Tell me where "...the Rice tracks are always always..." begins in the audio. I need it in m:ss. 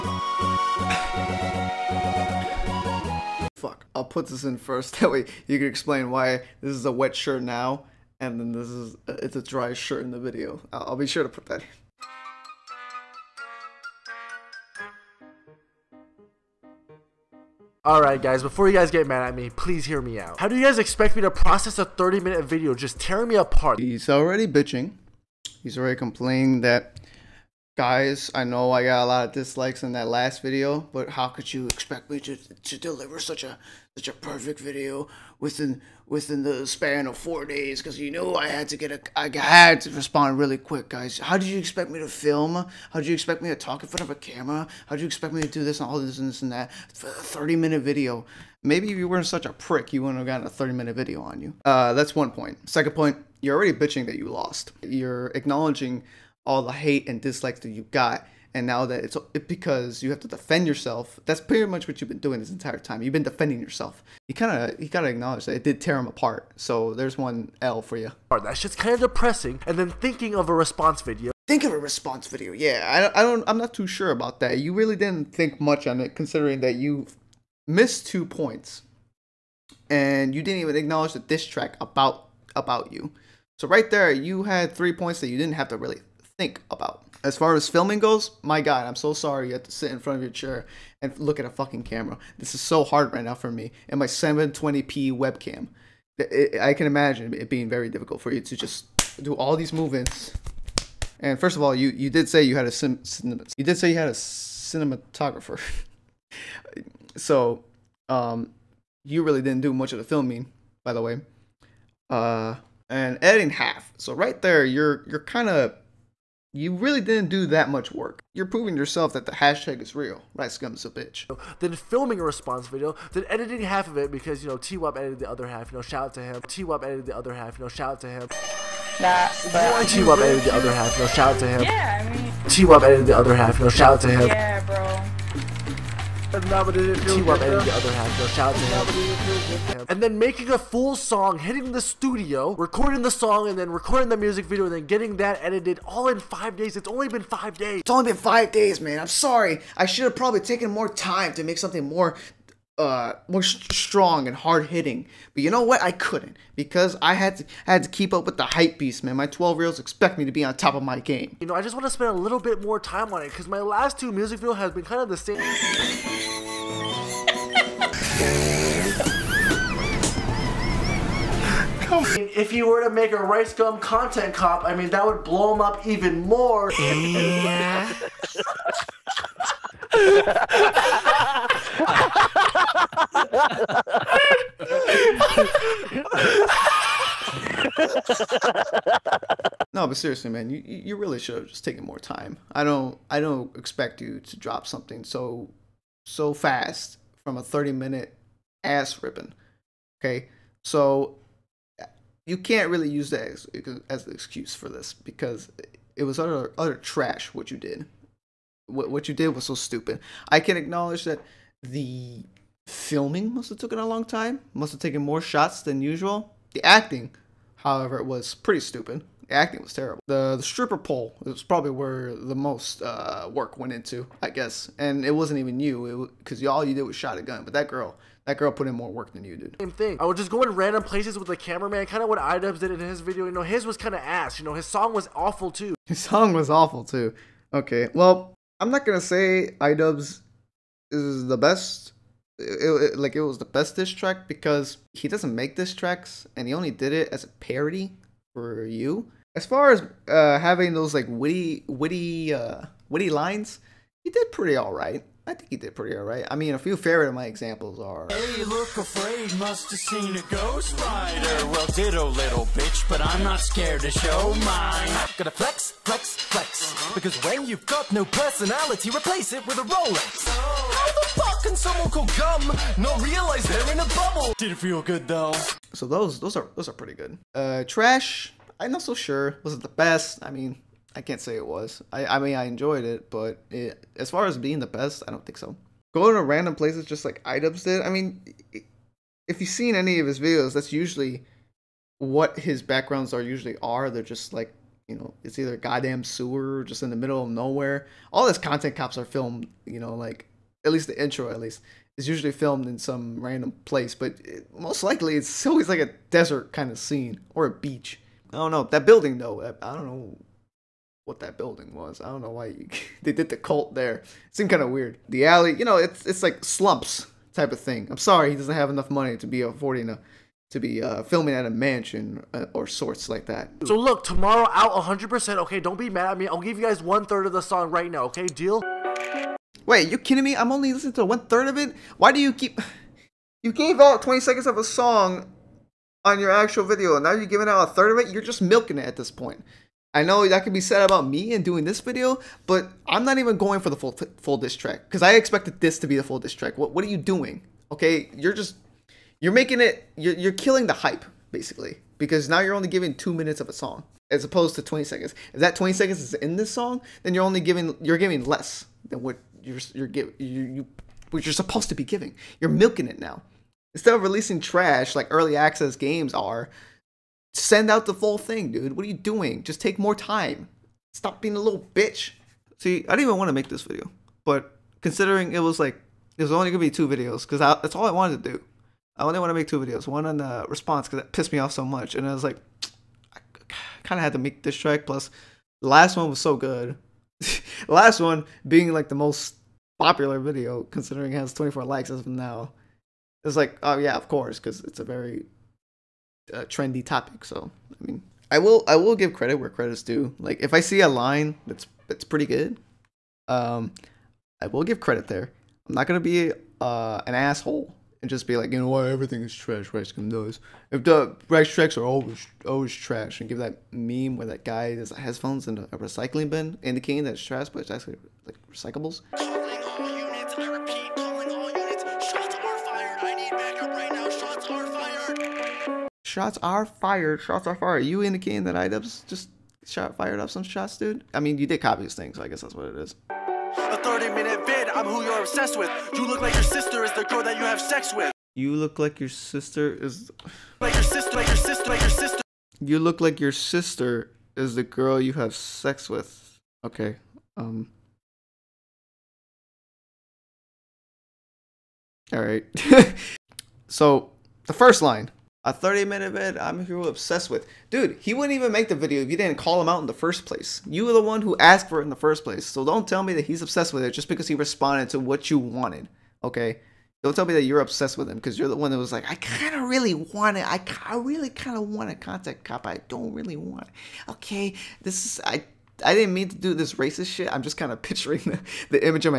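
6:50.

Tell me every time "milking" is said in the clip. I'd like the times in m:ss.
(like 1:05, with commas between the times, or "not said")
5:38, 6:02.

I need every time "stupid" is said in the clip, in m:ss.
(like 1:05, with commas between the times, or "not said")
3:29, 3:38.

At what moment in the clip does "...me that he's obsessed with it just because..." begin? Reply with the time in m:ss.
7:43.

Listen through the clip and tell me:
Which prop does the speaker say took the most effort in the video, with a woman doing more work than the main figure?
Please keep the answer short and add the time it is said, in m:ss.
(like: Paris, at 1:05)
stripper pole, at 3:40.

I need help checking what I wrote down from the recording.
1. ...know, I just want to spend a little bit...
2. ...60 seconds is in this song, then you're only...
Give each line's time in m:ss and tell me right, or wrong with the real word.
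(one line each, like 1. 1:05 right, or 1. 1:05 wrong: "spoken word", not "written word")
1. 2:41 right
2. 5:55 wrong: "20", not "60".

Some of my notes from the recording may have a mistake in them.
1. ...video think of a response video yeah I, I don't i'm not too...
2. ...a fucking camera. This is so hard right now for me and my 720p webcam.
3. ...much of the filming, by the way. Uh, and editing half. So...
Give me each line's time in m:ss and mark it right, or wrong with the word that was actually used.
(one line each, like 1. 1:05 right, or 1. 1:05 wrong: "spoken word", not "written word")
1. 1:11 right
2. 1:31 right
3. 1:49 right.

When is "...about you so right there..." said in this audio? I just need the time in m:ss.
1:22.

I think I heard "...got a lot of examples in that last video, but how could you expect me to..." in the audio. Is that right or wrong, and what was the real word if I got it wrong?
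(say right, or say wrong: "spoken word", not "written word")
wrong: "dislikes", not "examples".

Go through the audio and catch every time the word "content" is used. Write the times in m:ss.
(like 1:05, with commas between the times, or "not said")
2:53, 4:58, 7:51.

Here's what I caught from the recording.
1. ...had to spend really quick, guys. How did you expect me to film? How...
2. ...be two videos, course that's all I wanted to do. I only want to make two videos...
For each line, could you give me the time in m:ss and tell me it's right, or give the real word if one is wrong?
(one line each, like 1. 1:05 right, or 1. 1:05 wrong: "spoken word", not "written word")
1. 0:39 wrong: "respond", not "spend"
2. 6:16 wrong: "cause", not "course".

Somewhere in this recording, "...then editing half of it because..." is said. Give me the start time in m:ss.
2:03.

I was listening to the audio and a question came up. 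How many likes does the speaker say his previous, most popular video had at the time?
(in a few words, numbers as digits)
24.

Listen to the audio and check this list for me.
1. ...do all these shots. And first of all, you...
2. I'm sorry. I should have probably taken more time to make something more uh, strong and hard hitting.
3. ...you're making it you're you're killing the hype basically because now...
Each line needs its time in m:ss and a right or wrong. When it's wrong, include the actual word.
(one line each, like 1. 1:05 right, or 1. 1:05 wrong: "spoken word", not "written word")
1. 1:39 wrong: "movements", not "shots"
2. 2:29 right
3. 5:49 right.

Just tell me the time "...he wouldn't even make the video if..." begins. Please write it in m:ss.
7:37.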